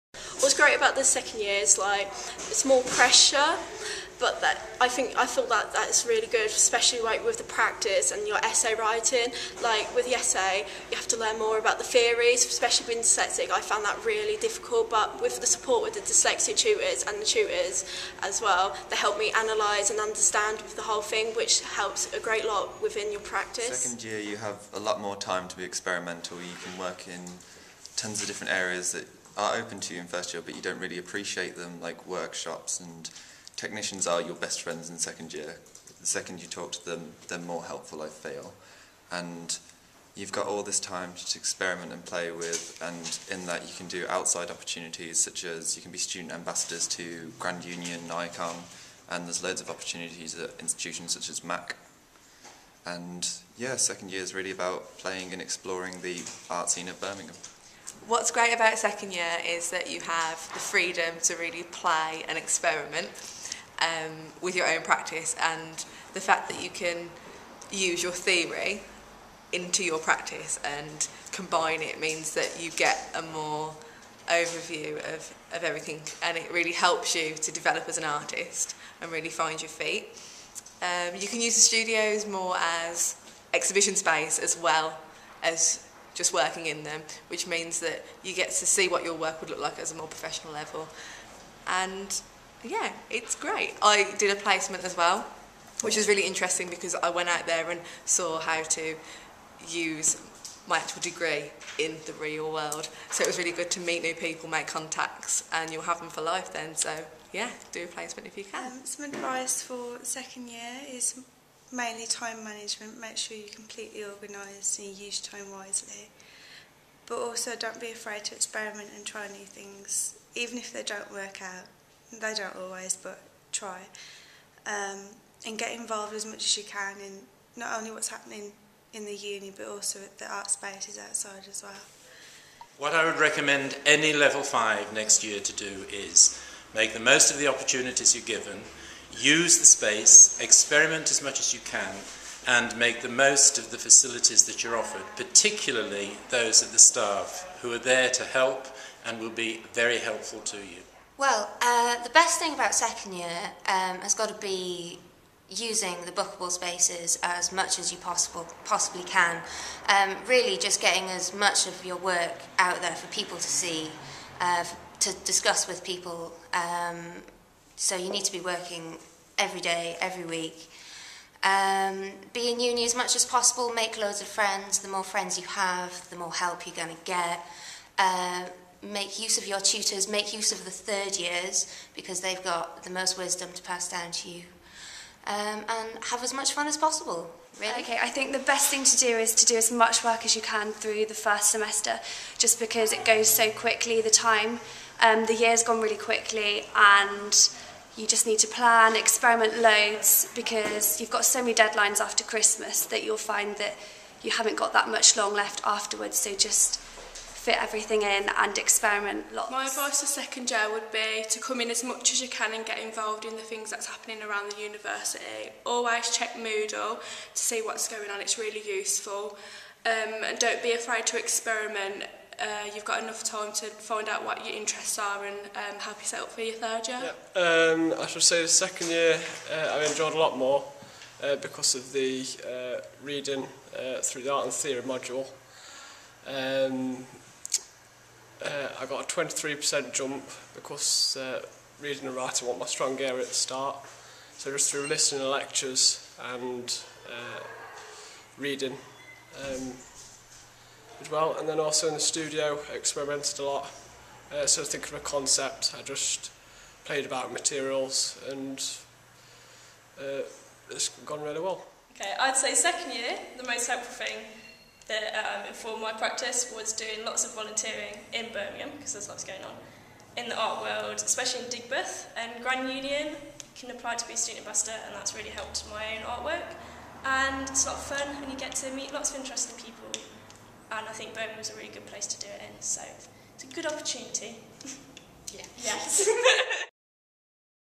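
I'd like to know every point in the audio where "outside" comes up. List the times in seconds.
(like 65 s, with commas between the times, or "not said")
44 s, 130 s.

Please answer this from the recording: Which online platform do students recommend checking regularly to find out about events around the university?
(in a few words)
Moodle.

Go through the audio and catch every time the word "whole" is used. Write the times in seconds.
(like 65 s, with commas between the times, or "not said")
20 s.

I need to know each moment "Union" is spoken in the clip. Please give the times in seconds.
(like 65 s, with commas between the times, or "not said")
47 s, 272 s.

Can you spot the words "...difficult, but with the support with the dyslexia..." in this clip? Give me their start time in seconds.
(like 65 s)
14 s.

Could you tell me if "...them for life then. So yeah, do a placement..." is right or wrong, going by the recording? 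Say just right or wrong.
right.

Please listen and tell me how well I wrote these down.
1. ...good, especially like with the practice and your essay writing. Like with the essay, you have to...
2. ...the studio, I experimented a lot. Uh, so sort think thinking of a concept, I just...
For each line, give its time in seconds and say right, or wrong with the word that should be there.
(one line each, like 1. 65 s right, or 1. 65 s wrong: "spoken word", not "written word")
1. 6 s right
2. 251 s right.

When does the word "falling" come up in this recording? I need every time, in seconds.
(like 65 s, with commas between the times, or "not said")
not said.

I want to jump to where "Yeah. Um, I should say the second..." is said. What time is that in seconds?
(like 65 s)
227 s.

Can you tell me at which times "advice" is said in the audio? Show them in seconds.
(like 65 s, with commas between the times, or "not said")
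109 s, 209 s.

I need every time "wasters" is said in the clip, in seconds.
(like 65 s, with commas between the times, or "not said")
not said.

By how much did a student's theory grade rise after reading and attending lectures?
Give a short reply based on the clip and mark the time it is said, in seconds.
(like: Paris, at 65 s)
23%, at 239 s.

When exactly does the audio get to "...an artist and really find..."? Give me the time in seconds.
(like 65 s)
77 s.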